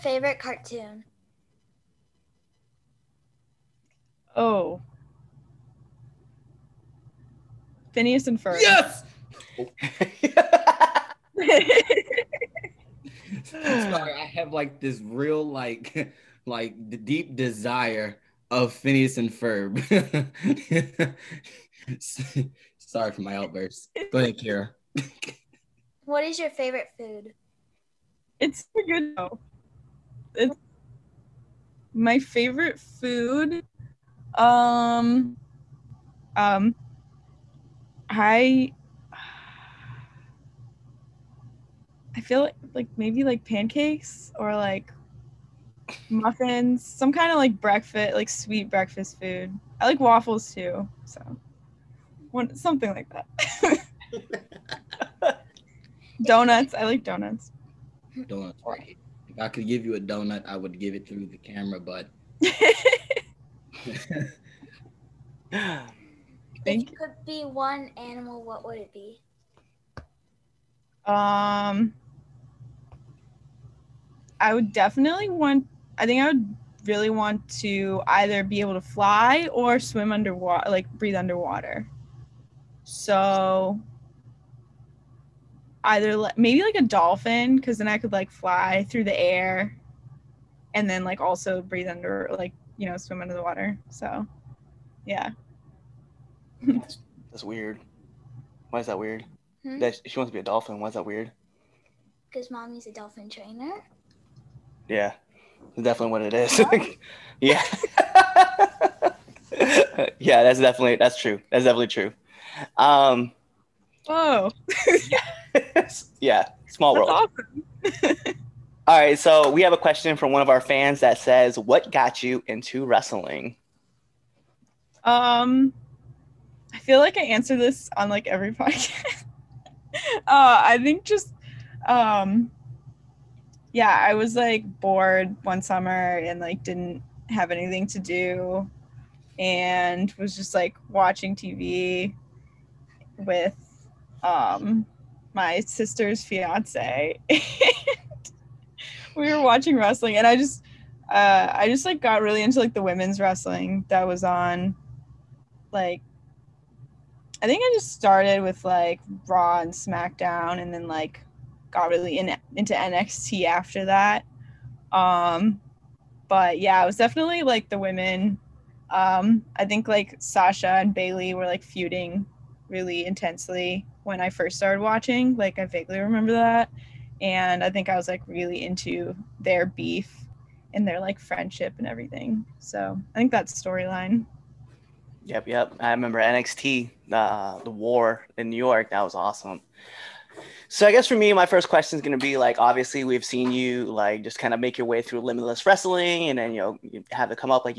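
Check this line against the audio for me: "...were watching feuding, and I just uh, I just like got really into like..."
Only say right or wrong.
wrong.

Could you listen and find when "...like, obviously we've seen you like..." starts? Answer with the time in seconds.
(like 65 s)
192 s.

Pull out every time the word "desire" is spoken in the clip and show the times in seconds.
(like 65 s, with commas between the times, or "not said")
17 s.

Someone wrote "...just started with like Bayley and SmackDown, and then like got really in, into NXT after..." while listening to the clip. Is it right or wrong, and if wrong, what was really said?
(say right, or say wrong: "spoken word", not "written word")
wrong: "Raw", not "Bayley".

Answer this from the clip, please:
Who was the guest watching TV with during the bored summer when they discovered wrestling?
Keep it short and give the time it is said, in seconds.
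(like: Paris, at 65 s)
Sister's fiance, at 145 s.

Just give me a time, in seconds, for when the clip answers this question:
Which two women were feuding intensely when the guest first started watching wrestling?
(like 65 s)
170 s.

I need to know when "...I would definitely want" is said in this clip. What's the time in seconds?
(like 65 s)
74 s.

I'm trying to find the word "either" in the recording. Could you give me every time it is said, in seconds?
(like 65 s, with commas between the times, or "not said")
78 s, 85 s.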